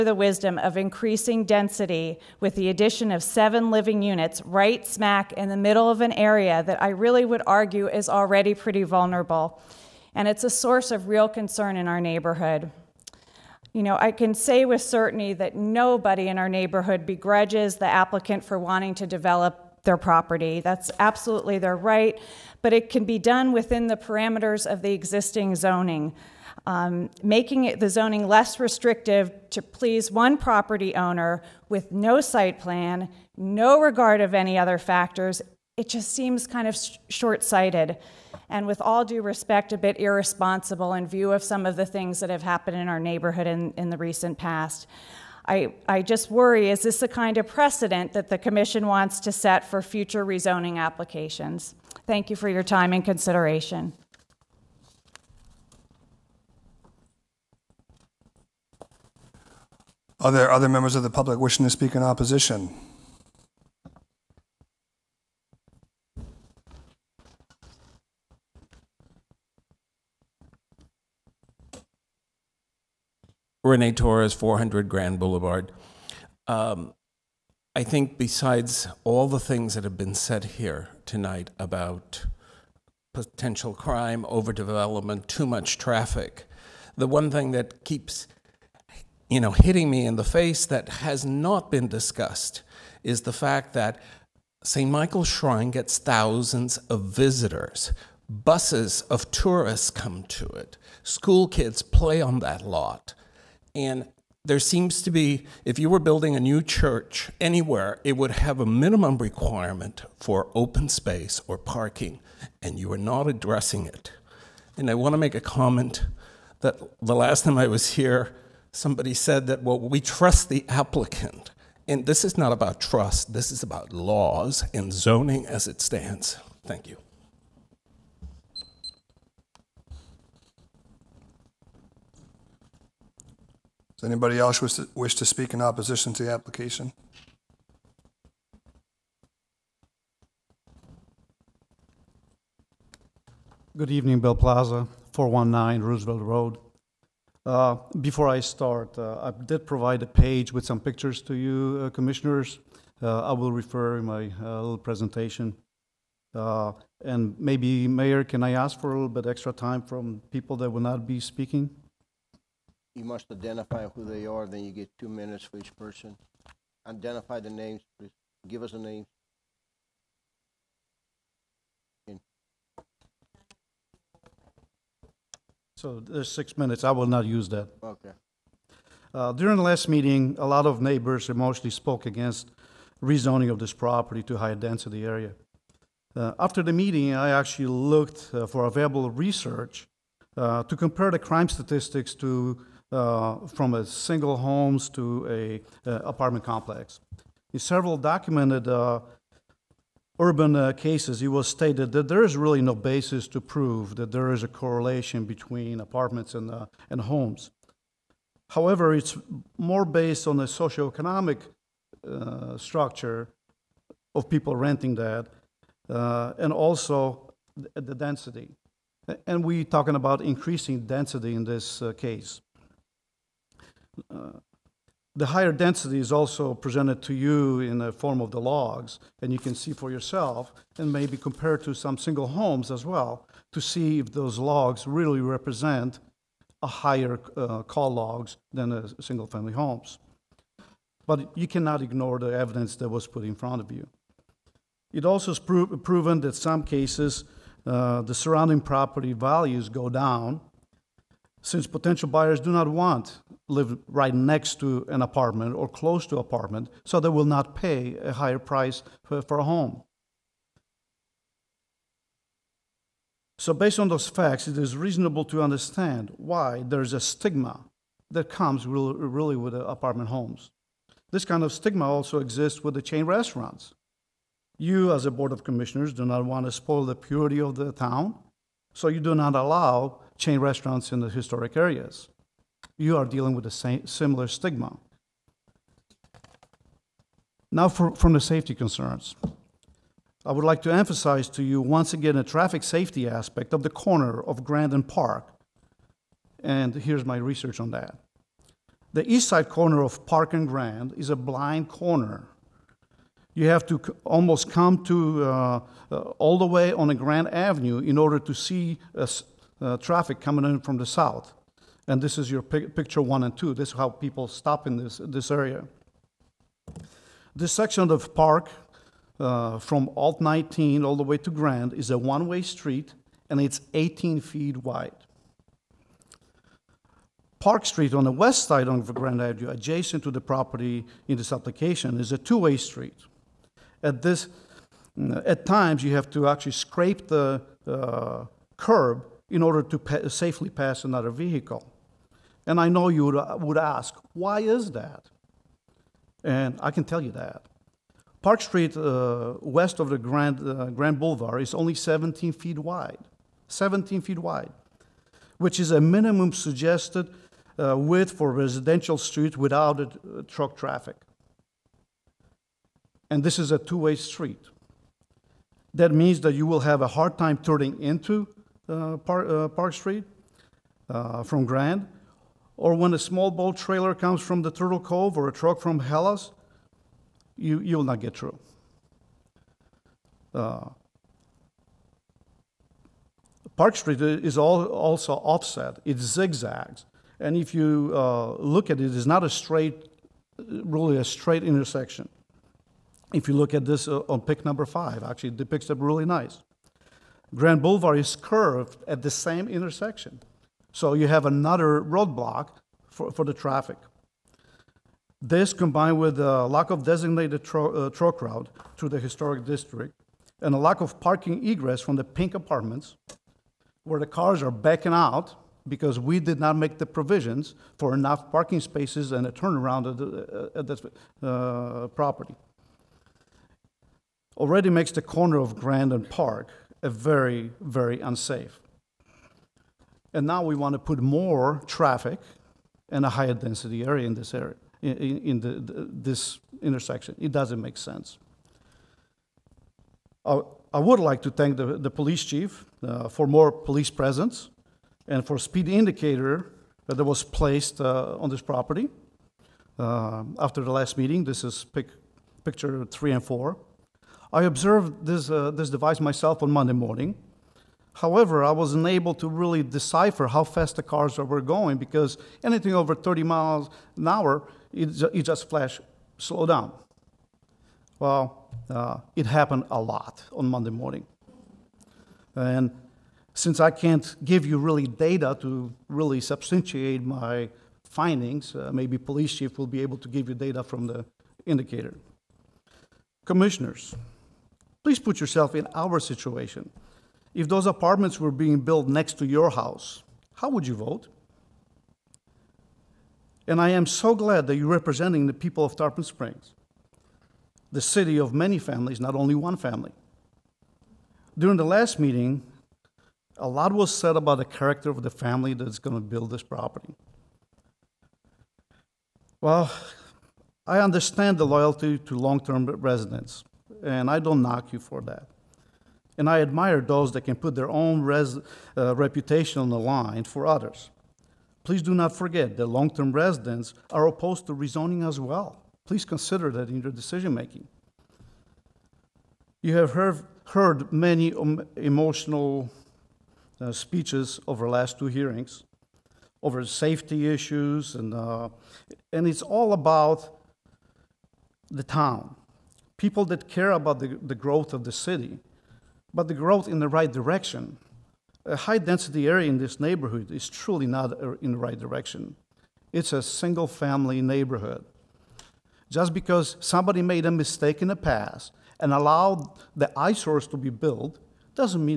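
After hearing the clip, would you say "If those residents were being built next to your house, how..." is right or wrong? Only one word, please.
wrong.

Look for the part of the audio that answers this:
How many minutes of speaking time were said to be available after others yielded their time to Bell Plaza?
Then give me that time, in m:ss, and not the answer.
2:56.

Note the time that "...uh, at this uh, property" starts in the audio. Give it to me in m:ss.
7:00.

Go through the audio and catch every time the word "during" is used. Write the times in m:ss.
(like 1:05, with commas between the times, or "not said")
2:59, 8:21.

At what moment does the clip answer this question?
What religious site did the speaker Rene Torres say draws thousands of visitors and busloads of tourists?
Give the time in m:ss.
1:34.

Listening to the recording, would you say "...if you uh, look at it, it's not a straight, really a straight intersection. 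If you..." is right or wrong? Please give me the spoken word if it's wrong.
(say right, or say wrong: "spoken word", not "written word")
right.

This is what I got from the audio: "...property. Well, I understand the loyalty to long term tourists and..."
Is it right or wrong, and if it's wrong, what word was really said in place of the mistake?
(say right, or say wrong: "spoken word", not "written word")
wrong: "residents", not "tourists".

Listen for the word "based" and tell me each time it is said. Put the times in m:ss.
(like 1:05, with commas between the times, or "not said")
3:29, 4:23.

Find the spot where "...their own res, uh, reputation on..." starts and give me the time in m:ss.
8:37.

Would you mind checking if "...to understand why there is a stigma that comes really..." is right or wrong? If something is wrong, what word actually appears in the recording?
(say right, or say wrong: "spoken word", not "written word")
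right.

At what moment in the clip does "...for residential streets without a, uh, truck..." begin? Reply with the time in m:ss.
5:58.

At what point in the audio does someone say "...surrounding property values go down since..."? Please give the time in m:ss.
4:08.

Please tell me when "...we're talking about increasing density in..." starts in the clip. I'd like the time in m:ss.
3:39.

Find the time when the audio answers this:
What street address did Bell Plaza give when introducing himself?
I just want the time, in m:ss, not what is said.
2:25.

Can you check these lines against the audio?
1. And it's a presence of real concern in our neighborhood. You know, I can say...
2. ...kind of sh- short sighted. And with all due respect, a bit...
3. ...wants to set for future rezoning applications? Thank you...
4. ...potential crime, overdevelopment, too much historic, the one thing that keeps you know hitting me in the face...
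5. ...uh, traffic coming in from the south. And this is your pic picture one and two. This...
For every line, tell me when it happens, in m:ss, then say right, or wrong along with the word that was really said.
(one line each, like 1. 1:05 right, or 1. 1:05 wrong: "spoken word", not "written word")
1. 0:10 wrong: "source", not "presence"
2. 0:36 right
3. 0:48 right
4. 1:23 wrong: "traffic", not "historic"
5. 5:09 right.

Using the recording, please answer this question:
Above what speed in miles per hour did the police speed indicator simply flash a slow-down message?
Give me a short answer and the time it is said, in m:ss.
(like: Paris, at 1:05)
30 mph, at 7:42.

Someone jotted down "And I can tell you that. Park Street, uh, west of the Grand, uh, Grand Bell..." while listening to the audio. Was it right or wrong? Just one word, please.
wrong.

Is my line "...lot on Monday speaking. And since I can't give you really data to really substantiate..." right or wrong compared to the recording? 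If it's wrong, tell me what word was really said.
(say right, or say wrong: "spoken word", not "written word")
wrong: "morning", not "speaking".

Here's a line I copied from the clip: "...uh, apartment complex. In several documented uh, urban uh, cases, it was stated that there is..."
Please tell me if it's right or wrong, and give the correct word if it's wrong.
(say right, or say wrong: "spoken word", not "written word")
right.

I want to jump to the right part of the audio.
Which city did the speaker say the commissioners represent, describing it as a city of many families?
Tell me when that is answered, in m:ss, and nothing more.
8:15.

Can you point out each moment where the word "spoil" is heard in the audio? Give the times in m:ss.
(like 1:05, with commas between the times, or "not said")
4:36.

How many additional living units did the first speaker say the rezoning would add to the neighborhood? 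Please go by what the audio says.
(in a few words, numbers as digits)
7.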